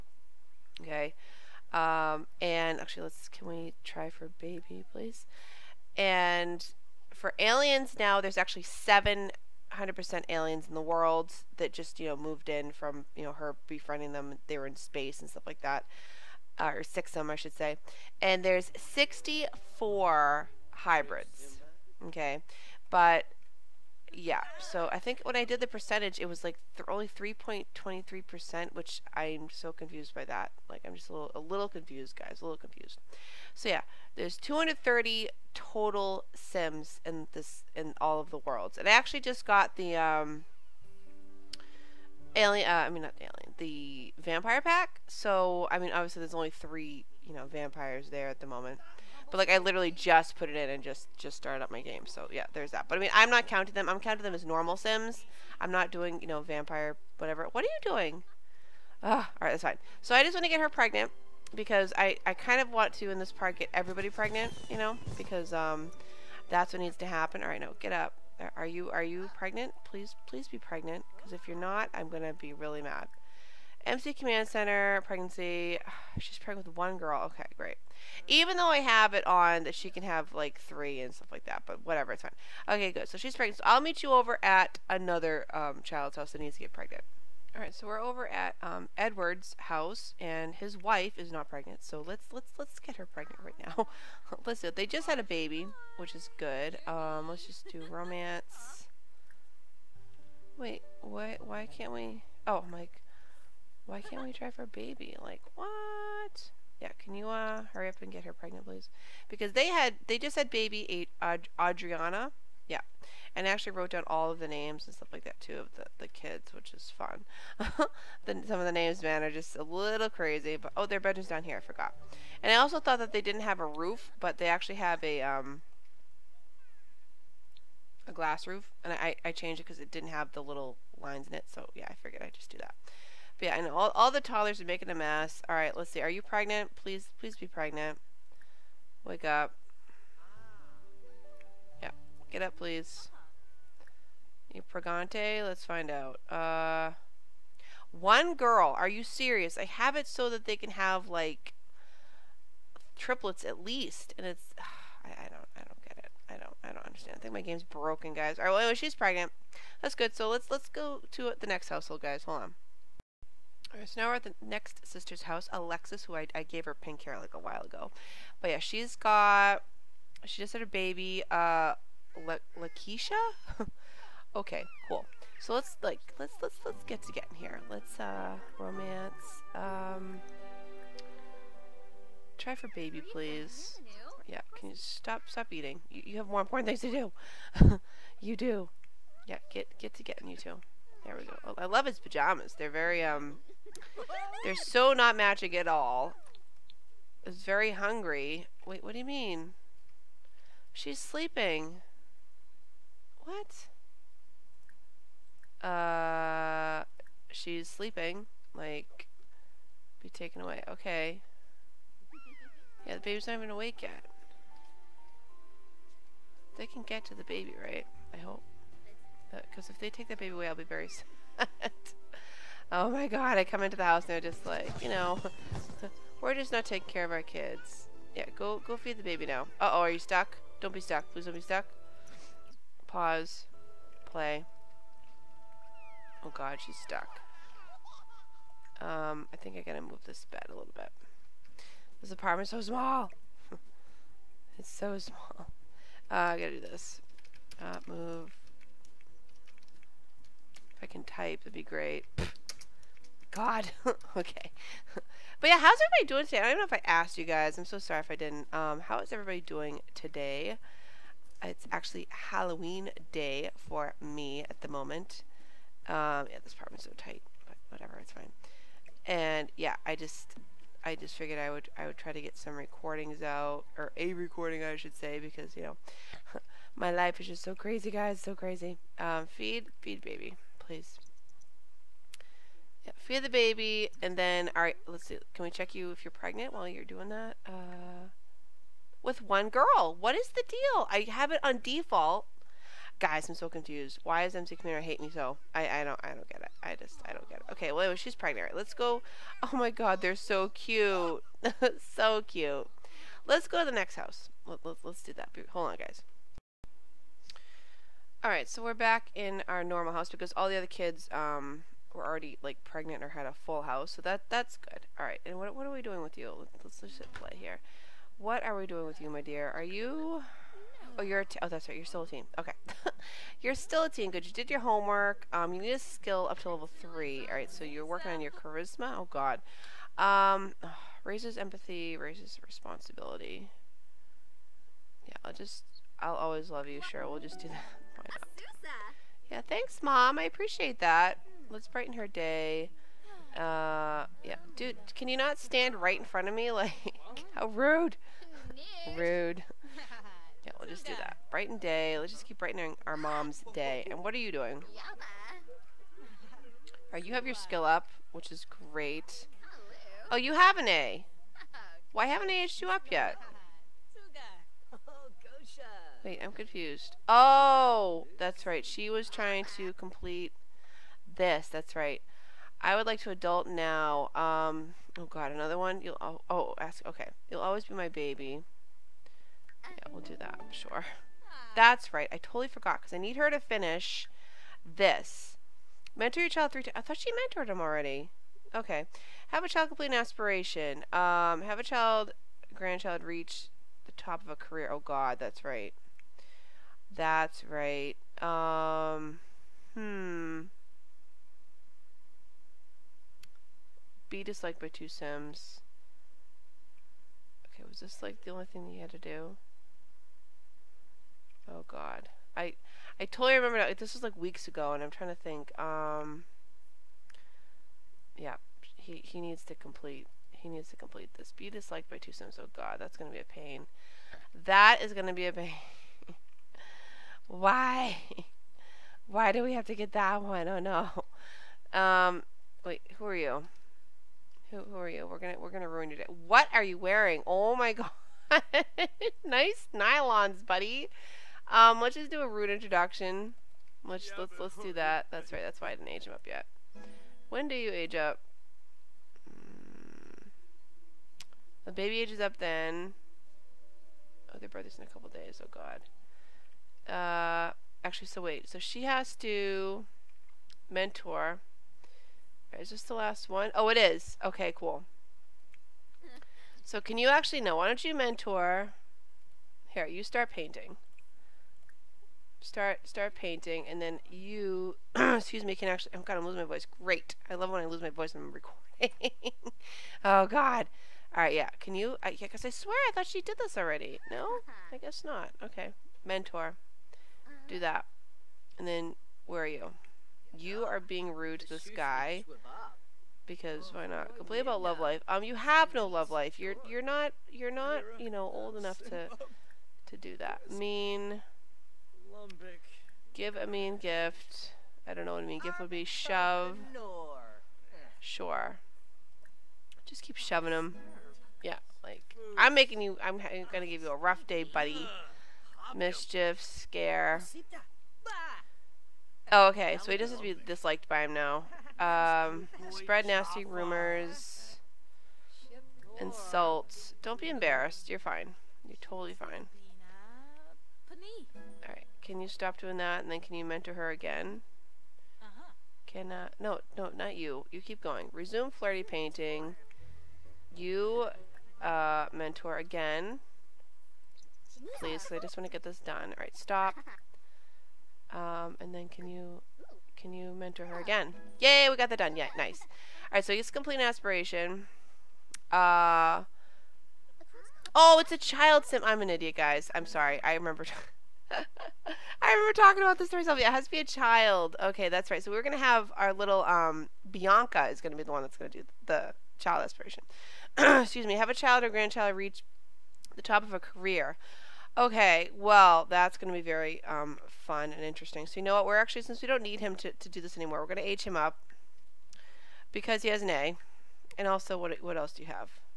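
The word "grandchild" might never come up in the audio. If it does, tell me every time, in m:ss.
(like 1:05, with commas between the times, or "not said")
6:32, 9:31.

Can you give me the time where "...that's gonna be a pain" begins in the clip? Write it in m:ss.
7:02.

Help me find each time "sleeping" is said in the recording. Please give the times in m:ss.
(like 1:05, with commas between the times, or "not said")
3:20, 3:27.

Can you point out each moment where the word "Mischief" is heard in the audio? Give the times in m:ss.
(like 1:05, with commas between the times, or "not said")
8:35.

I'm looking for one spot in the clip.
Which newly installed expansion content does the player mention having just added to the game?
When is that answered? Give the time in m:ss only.
0:43.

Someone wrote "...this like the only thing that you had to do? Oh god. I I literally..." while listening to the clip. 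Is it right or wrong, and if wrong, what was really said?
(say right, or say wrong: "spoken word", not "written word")
wrong: "totally", not "literally".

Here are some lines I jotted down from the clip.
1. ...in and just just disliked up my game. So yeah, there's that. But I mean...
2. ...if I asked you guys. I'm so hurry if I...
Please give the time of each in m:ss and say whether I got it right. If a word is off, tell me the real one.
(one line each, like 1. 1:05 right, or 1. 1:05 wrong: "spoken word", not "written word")
1. 0:50 wrong: "started", not "disliked"
2. 4:16 wrong: "sorry", not "hurry".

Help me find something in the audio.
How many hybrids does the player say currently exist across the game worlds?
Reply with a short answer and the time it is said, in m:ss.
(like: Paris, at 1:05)
64, at 0:18.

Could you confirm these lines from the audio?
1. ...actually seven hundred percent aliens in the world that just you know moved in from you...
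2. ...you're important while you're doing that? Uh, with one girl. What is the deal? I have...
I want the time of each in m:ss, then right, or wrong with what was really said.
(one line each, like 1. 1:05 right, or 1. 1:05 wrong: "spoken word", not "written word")
1. 0:08 right
2. 4:46 wrong: "pregnant", not "important".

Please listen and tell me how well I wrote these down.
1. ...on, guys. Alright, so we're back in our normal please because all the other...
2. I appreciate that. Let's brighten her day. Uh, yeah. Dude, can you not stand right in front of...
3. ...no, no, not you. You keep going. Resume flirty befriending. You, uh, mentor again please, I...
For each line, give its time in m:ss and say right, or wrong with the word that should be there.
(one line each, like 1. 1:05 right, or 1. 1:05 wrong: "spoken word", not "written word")
1. 5:05 wrong: "house", not "please"
2. 5:40 right
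3. 8:56 wrong: "painting", not "befriending".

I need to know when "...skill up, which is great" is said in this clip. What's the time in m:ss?
5:57.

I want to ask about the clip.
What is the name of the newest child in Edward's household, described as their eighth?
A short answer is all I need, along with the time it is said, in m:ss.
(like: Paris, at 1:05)
Adriana, at 1:51.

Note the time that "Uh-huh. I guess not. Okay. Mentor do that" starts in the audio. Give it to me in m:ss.
8:04.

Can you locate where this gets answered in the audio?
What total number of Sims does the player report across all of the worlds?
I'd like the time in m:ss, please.
0:34.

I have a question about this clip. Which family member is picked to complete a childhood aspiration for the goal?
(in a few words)
Bianca.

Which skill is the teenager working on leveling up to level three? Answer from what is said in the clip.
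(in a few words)
charisma.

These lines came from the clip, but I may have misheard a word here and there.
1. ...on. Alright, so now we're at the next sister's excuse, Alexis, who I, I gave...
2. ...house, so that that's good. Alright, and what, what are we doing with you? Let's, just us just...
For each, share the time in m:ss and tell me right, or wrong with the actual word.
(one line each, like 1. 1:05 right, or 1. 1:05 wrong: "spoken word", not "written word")
1. 2:42 wrong: "house", not "excuse"
2. 5:13 right.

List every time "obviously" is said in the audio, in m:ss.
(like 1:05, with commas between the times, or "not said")
0:45.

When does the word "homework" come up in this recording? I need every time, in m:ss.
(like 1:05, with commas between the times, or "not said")
5:24.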